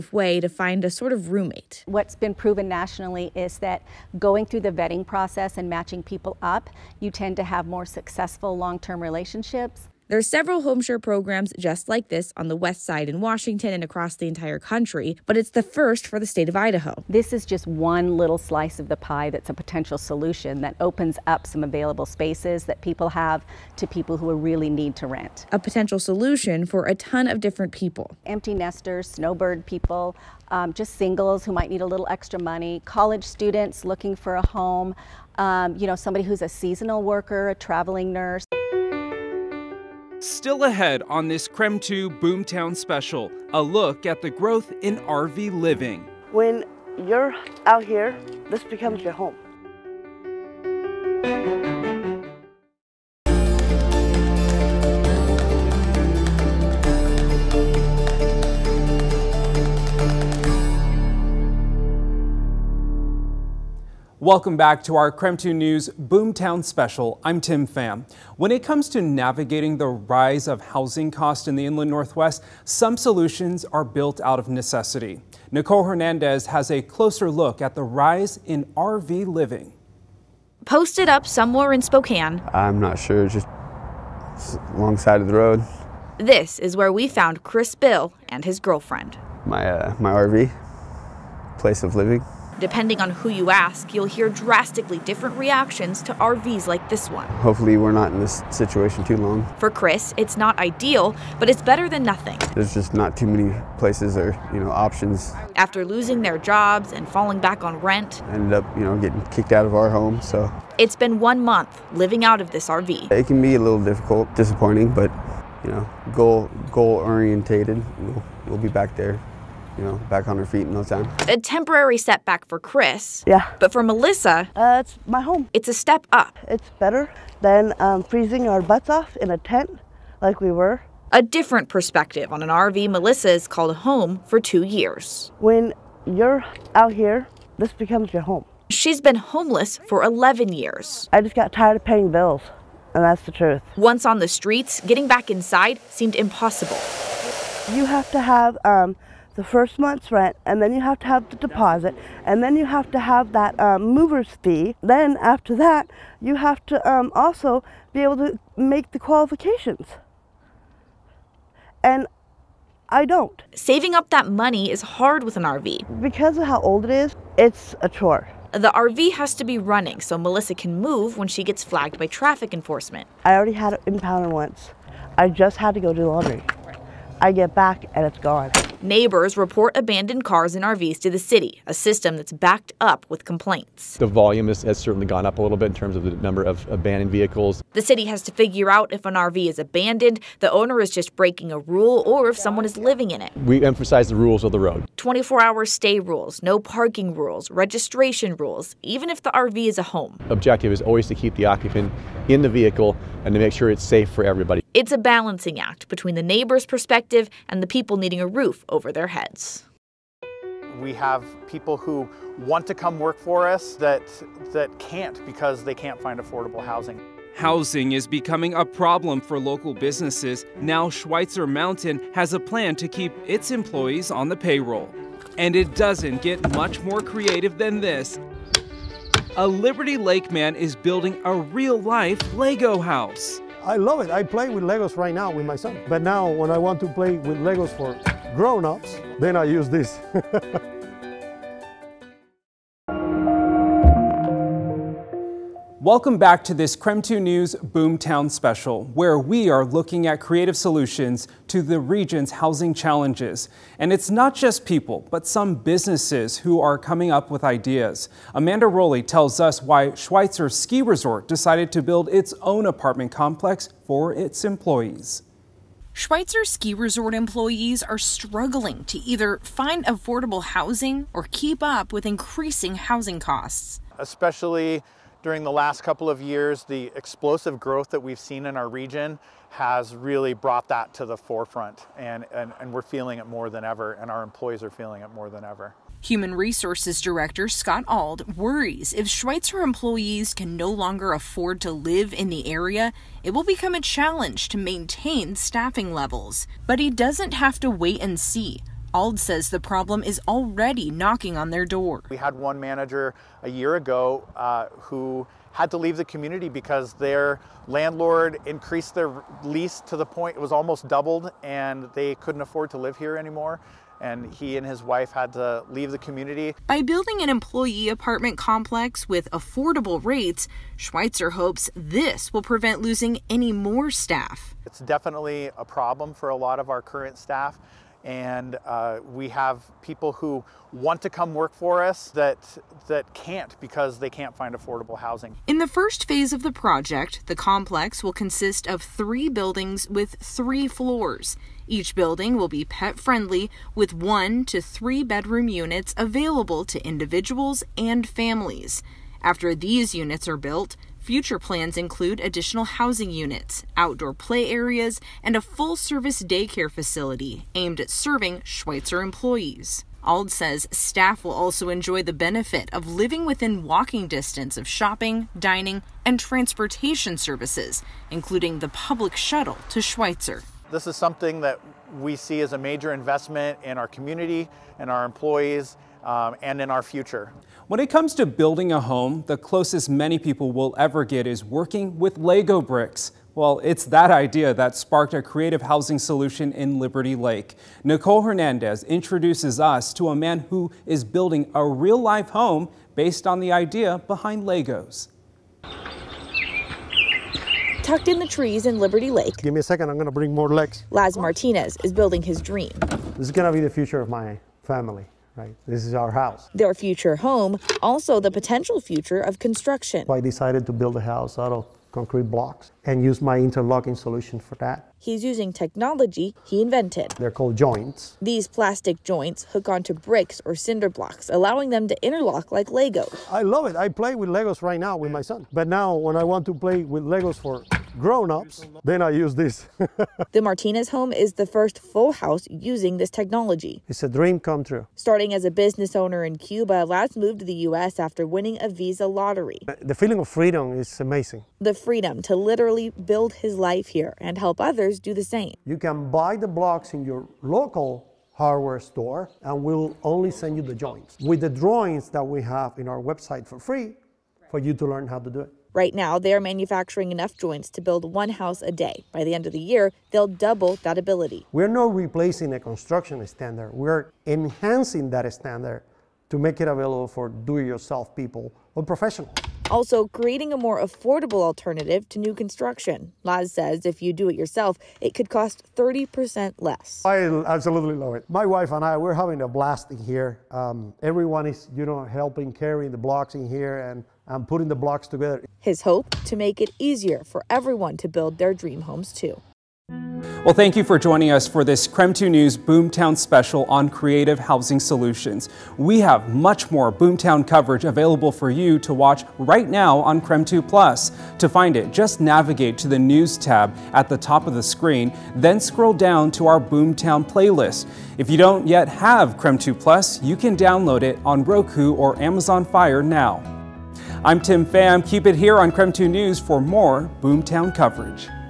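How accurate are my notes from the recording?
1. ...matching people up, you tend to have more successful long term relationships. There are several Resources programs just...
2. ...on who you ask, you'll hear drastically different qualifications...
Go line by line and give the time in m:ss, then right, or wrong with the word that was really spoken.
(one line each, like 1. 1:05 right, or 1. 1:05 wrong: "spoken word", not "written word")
1. 0:05 wrong: "HomeShare", not "Resources"
2. 1:33 wrong: "reactions", not "qualifications".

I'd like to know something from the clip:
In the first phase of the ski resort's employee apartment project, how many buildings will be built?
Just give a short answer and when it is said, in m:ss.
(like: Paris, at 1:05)
3, at 5:38.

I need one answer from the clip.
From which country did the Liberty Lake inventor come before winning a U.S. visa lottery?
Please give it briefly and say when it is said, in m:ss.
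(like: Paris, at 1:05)
Cuba, at 7:16.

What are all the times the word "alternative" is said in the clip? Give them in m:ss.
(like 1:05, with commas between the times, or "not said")
7:51.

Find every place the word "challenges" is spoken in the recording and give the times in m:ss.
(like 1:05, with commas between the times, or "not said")
4:12, 4:53.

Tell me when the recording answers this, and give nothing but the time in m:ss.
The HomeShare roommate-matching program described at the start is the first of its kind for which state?
0:16.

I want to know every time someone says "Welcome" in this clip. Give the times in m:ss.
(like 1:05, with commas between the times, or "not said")
1:04, 4:05.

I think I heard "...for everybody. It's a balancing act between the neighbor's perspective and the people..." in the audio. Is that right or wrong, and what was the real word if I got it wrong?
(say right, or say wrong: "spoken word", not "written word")
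right.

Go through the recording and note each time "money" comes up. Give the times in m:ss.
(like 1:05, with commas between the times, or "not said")
0:32, 2:44.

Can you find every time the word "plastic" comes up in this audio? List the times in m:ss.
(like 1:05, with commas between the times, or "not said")
6:58.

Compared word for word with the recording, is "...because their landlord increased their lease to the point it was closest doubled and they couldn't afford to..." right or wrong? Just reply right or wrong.
wrong.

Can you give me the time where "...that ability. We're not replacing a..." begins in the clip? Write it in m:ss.
7:40.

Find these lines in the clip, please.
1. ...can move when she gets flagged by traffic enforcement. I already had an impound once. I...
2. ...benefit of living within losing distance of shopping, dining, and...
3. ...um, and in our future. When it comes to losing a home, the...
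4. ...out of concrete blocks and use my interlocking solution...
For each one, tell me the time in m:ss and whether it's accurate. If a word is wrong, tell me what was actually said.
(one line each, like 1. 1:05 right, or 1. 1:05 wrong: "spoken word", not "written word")
1. 2:50 right
2. 6:02 wrong: "walking", not "losing"
3. 6:16 wrong: "building", not "losing"
4. 6:51 right.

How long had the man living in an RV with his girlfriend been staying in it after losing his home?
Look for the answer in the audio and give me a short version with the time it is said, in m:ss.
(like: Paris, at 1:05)
One month, at 1:51.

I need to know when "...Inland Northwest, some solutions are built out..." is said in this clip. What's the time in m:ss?
1:11.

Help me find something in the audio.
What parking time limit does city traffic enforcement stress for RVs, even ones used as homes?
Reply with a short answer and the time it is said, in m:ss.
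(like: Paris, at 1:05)
24-hour, at 3:14.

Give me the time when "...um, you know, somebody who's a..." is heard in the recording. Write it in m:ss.
0:35.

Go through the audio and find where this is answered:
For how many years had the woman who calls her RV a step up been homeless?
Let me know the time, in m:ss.
2:20.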